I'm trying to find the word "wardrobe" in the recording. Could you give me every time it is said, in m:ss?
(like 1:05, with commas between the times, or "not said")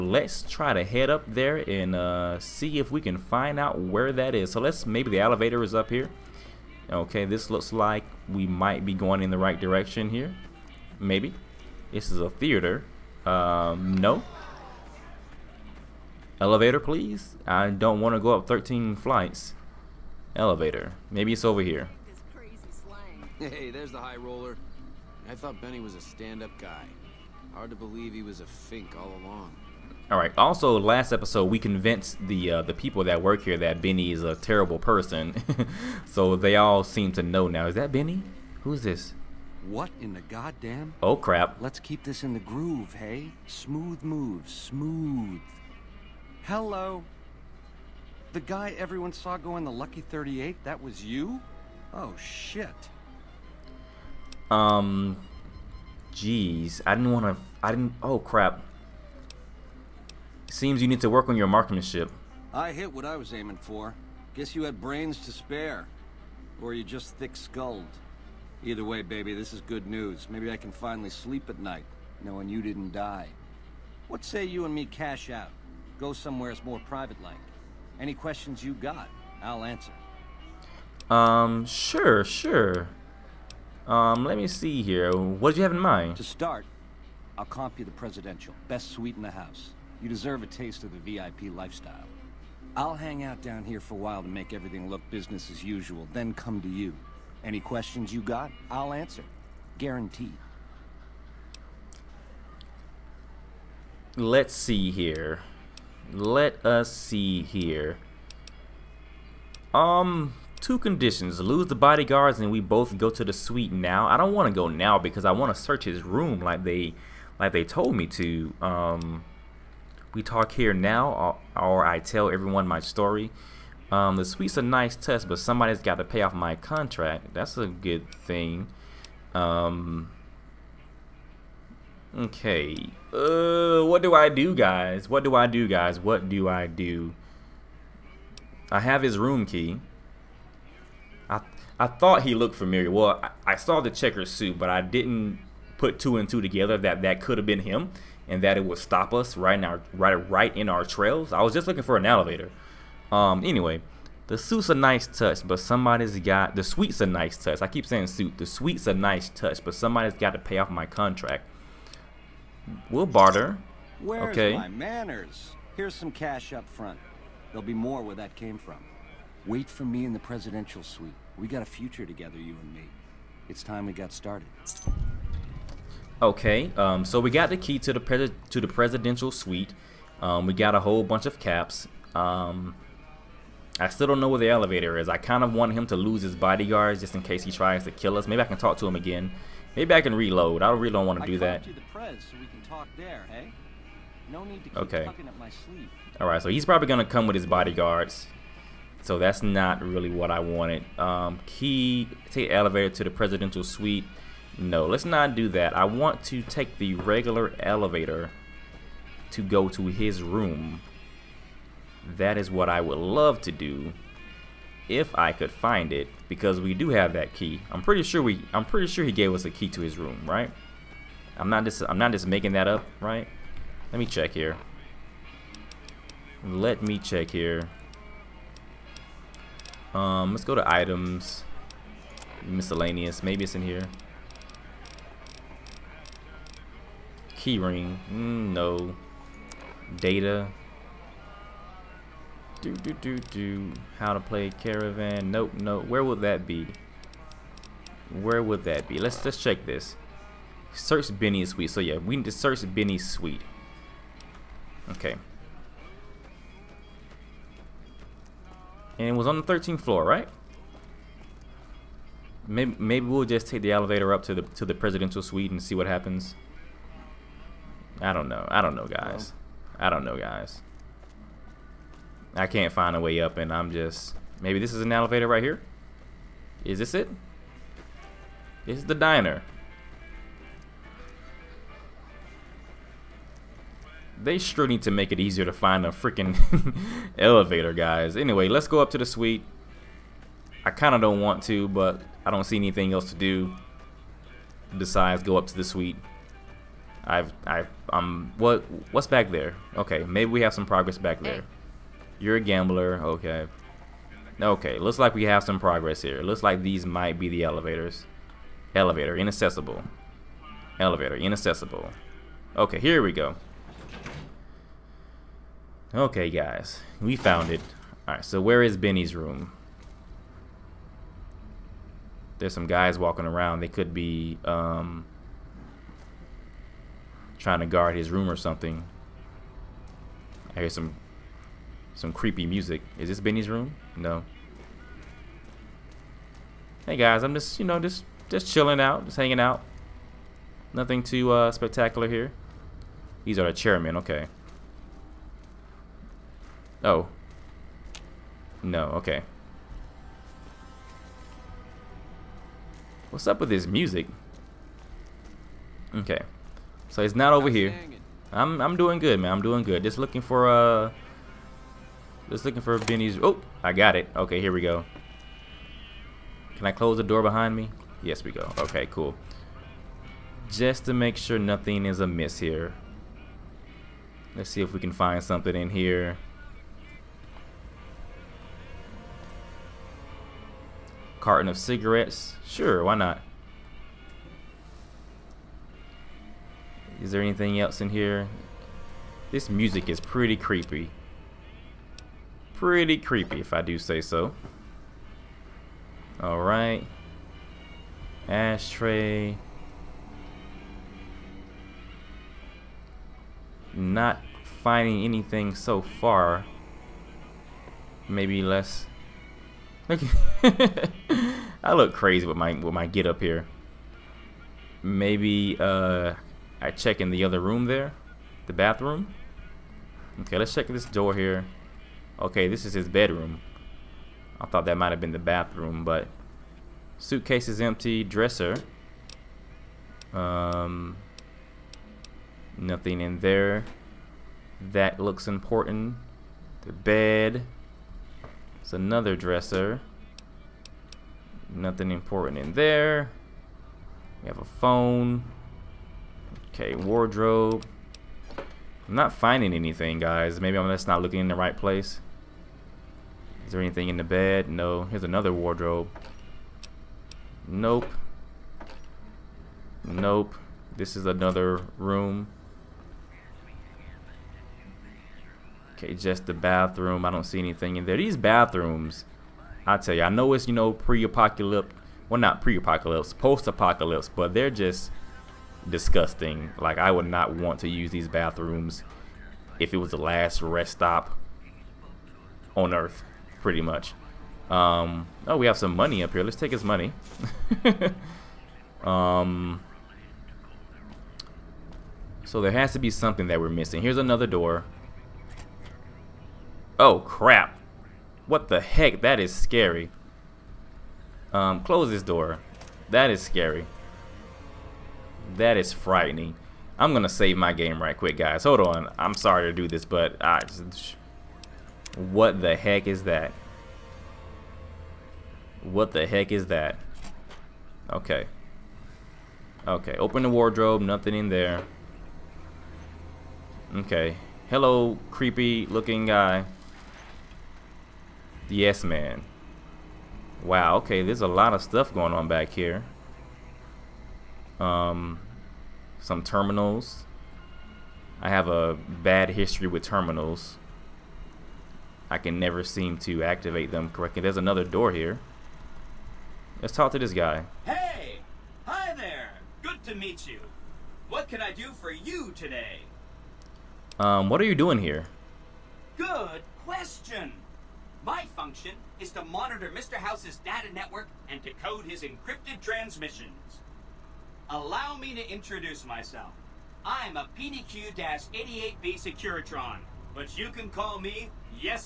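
7:26, 7:35, 8:40.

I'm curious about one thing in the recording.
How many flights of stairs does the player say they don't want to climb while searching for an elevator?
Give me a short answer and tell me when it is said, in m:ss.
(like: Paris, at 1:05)
13, at 0:18.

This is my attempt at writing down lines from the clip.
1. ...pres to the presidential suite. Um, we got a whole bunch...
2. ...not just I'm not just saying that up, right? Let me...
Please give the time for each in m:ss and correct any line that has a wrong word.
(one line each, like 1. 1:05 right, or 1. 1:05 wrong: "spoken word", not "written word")
1. 2:58 right
2. 3:41 wrong: "making", not "saying".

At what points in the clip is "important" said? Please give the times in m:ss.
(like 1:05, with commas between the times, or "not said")
7:15, 7:21.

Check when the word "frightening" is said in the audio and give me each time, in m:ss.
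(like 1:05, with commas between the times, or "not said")
8:25.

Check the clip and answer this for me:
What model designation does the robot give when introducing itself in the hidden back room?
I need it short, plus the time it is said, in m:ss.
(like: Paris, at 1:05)
PDQ-88B Securitron, at 9:27.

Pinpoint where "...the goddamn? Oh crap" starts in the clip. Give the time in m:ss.
0:40.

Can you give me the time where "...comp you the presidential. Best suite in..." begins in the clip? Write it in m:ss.
1:27.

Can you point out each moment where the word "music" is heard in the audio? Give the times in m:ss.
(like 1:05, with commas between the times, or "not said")
5:32, 5:53, 6:29.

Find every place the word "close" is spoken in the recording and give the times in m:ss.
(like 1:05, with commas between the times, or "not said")
6:06, 8:21.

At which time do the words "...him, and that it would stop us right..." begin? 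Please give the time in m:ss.
2:27.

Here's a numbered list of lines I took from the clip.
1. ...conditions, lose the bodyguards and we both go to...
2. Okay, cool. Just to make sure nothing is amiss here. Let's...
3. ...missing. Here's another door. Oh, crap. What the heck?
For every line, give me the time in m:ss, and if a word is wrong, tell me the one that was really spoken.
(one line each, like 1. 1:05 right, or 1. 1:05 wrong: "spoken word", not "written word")
1. 1:50 right
2. 6:08 right
3. 8:13 right.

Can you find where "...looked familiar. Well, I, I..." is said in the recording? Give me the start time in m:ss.
2:22.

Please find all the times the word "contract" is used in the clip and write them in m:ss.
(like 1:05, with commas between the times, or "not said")
2:06, 2:40.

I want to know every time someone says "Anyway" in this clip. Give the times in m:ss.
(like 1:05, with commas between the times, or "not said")
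2:33, 4:48.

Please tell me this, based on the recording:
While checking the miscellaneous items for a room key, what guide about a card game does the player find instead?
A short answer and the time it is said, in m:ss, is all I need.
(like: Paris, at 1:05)
How to play Caravan, at 4:03.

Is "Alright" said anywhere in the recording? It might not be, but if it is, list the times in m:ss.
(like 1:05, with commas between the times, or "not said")
5:18, 6:36.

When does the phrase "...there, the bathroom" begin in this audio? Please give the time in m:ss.
6:57.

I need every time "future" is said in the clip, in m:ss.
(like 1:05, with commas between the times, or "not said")
2:51.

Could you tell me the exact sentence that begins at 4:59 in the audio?
Okay, maybe we have some progress back there.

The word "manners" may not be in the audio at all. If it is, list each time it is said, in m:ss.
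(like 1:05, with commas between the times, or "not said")
2:44.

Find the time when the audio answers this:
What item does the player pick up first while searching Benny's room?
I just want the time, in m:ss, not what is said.
6:21.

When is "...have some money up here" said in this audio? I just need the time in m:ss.
8:05.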